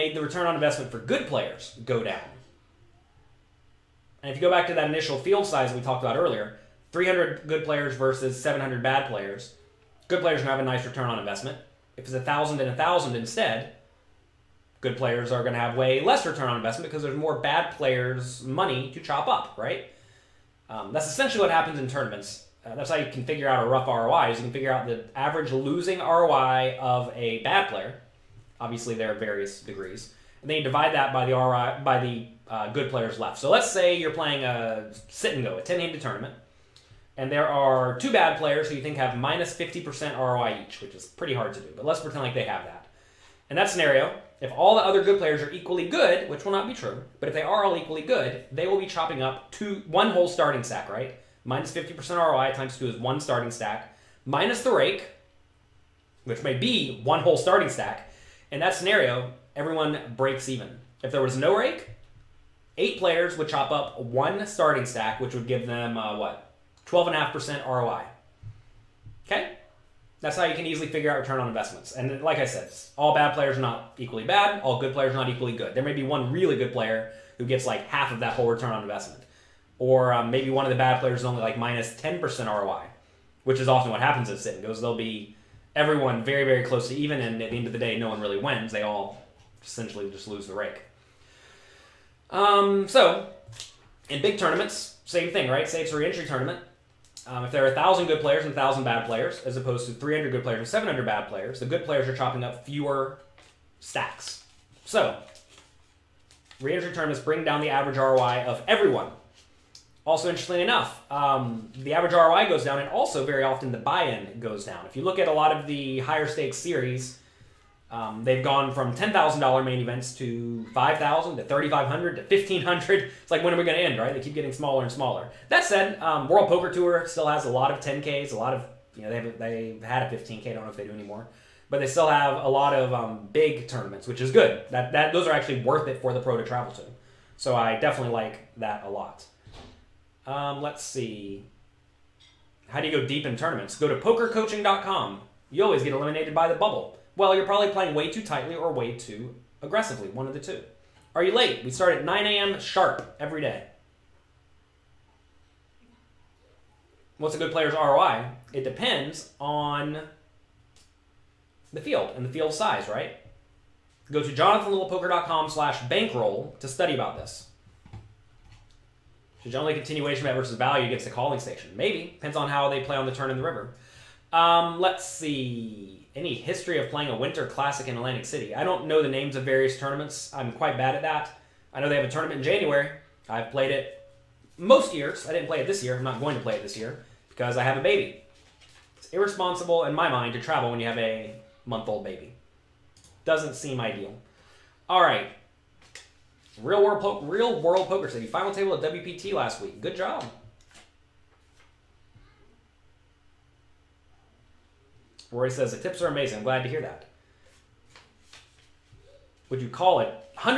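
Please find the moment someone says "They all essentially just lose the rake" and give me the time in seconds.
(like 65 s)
88 s.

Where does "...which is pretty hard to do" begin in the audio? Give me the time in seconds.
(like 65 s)
40 s.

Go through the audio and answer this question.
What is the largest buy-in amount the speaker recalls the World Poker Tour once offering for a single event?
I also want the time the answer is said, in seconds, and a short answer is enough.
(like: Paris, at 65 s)
15k, at 130 s.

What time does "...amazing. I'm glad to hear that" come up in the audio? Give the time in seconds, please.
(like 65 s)
206 s.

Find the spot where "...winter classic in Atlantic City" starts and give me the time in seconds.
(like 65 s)
177 s.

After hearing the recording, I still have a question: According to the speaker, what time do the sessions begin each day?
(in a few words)
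9 a.m.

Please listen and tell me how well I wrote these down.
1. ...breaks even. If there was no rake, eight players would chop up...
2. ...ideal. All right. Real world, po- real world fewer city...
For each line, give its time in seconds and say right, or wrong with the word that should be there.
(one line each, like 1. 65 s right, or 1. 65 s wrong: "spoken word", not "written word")
1. 60 s right
2. 193 s wrong: "poker", not "fewer".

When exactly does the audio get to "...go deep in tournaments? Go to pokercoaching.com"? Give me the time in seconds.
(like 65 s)
143 s.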